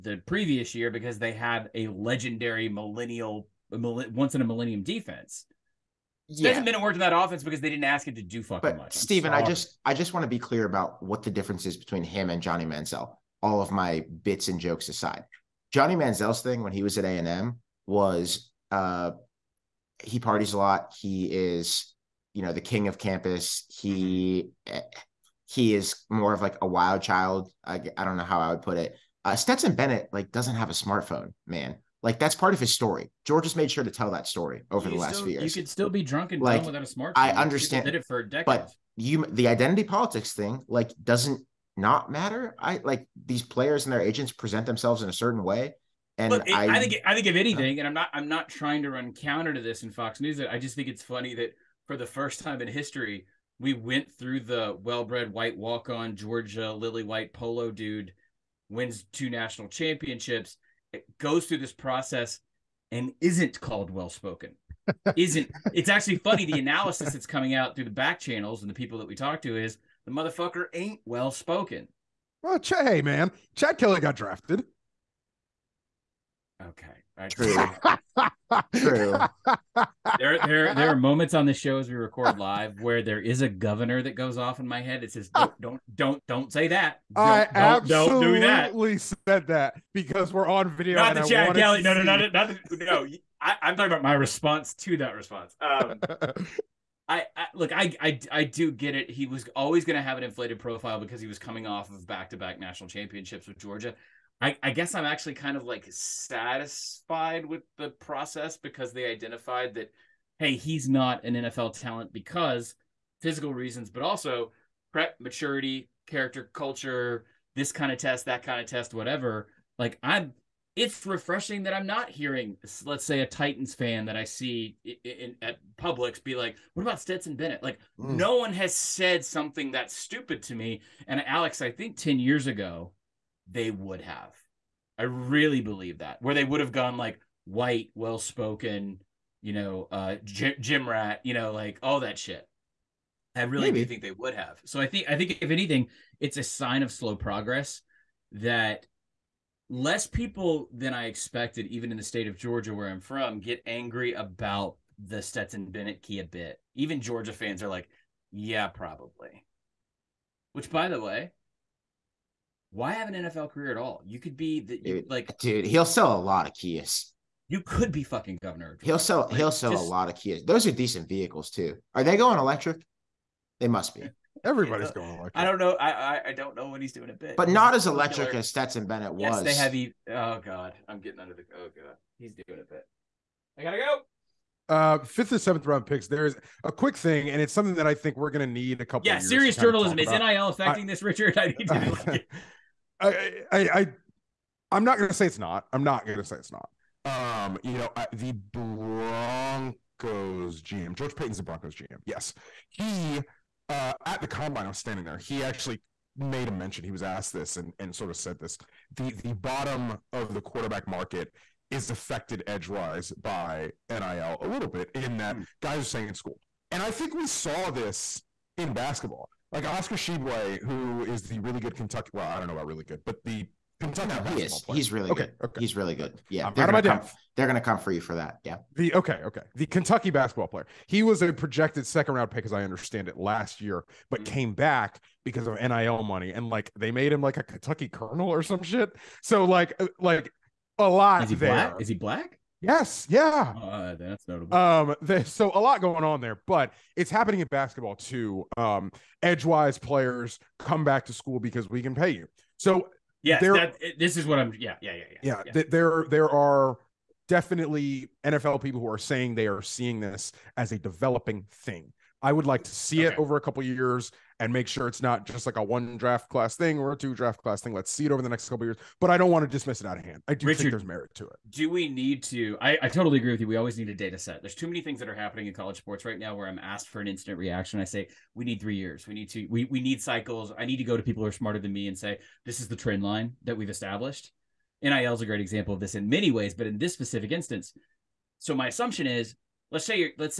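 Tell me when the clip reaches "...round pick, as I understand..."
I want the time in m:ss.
3:52.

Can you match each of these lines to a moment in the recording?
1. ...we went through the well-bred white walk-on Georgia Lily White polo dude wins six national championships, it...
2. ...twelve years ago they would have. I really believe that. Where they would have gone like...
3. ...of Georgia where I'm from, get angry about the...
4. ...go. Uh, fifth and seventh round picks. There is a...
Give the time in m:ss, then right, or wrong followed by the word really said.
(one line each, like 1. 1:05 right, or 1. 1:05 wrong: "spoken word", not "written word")
1. 0:53 wrong: "two", not "six"
2. 2:11 wrong: "ten", not "twelve"
3. 2:32 right
4. 3:03 right.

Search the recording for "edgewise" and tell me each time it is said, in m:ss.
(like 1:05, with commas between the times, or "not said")
3:32, 4:09.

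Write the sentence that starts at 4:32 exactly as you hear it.
I, I totally agree with you.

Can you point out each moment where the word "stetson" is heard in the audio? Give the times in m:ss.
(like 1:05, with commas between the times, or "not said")
0:29, 2:07, 2:35, 2:58.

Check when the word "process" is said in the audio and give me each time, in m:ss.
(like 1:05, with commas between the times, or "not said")
1:01, 1:47.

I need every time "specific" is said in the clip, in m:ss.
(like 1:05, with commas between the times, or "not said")
4:46.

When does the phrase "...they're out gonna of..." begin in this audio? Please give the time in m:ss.
3:46.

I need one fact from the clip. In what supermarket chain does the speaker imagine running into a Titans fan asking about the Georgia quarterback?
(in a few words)
Publix.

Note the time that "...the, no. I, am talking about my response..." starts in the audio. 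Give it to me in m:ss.
1:32.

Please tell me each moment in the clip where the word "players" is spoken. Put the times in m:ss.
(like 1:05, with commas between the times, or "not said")
0:43, 3:44, 3:50, 4:09.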